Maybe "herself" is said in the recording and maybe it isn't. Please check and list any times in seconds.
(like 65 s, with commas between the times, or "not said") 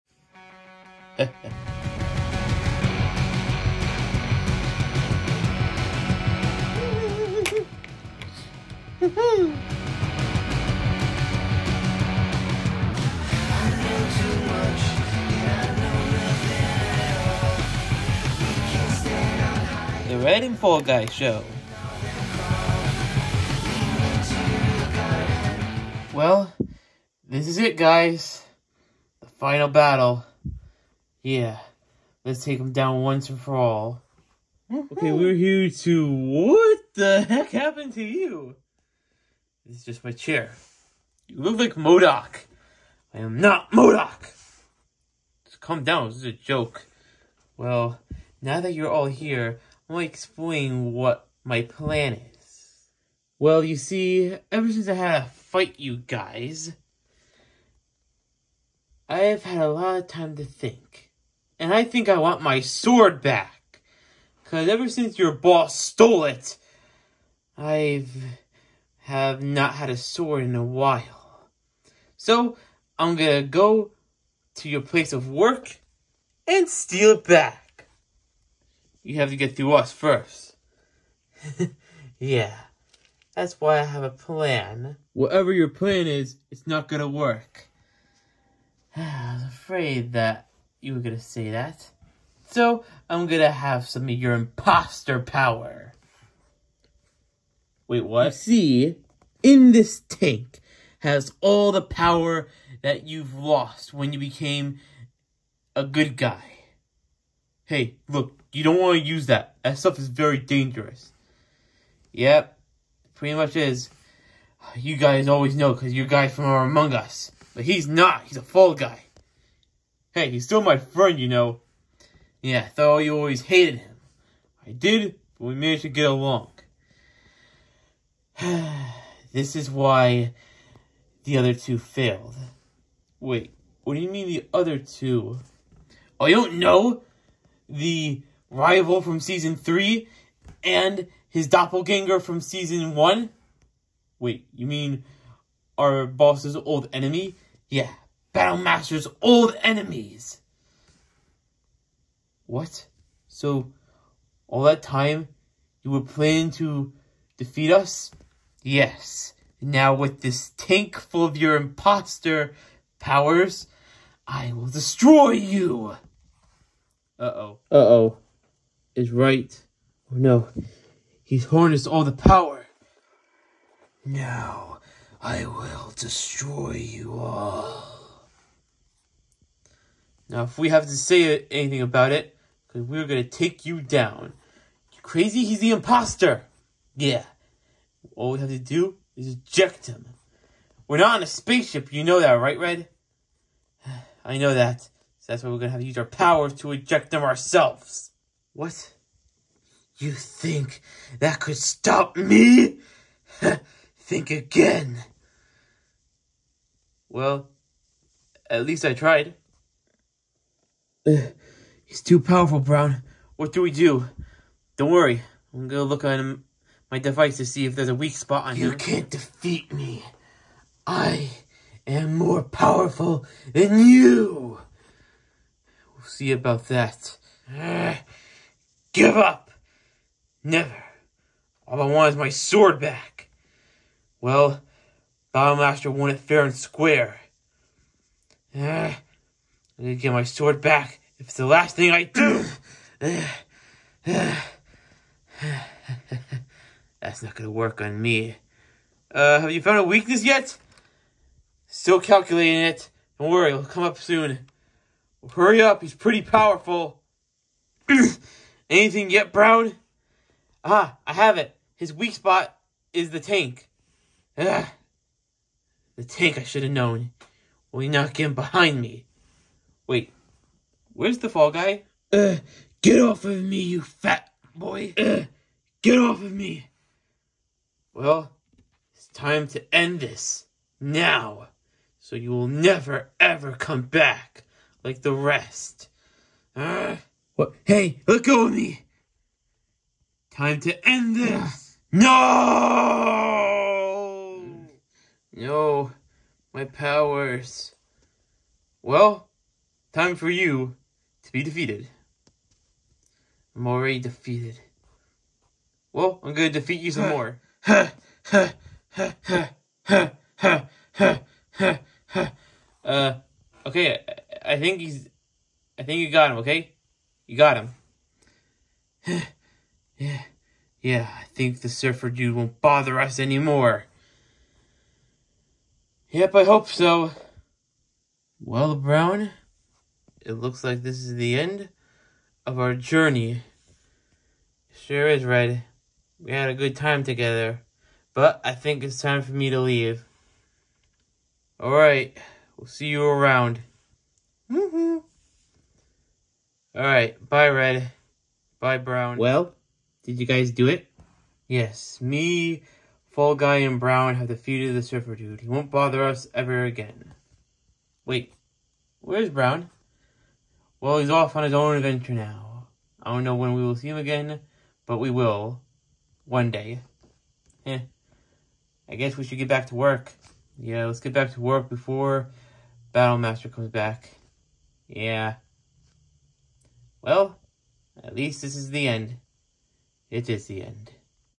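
not said.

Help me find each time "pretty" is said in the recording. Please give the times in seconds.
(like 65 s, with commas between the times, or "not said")
113 s, 255 s.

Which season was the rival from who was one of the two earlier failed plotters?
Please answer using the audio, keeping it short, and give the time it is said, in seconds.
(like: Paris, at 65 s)
Season three, at 139 s.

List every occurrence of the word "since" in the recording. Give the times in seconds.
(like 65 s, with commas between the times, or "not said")
54 s, 64 s.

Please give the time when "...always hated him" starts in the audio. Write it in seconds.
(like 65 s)
123 s.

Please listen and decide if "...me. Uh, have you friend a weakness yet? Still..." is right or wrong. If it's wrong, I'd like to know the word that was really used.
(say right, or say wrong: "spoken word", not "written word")
wrong: "found", not "friend".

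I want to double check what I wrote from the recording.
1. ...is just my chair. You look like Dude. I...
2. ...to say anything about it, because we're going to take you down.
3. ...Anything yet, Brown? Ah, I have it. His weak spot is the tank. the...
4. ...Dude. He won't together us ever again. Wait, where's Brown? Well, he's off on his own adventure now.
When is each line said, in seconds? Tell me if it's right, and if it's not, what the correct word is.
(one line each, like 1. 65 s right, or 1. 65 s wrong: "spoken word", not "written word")
1. 39 s wrong: "MODOK", not "Dude"
2. 180 s right
3. 258 s right
4. 355 s wrong: "bother", not "together".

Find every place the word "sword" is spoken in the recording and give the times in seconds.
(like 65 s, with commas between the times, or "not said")
62 s, 69 s, 232 s, 240 s.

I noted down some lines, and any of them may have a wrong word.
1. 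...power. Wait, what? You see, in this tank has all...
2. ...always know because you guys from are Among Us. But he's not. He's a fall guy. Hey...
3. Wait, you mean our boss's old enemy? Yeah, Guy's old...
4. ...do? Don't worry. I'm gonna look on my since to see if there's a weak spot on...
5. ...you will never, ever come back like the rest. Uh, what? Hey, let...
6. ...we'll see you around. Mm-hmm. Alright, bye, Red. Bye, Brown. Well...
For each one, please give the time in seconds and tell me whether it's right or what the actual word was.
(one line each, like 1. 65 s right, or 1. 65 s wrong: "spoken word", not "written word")
1. 95 s right
2. 115 s right
3. 144 s wrong: "Battlemaster", not "Guy"
4. 213 s wrong: "device", not "since"
5. 282 s right
6. 342 s right.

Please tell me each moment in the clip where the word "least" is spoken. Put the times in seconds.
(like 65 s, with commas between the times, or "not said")
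208 s, 378 s.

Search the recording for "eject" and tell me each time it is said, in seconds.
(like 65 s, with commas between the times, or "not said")
189 s, 196 s.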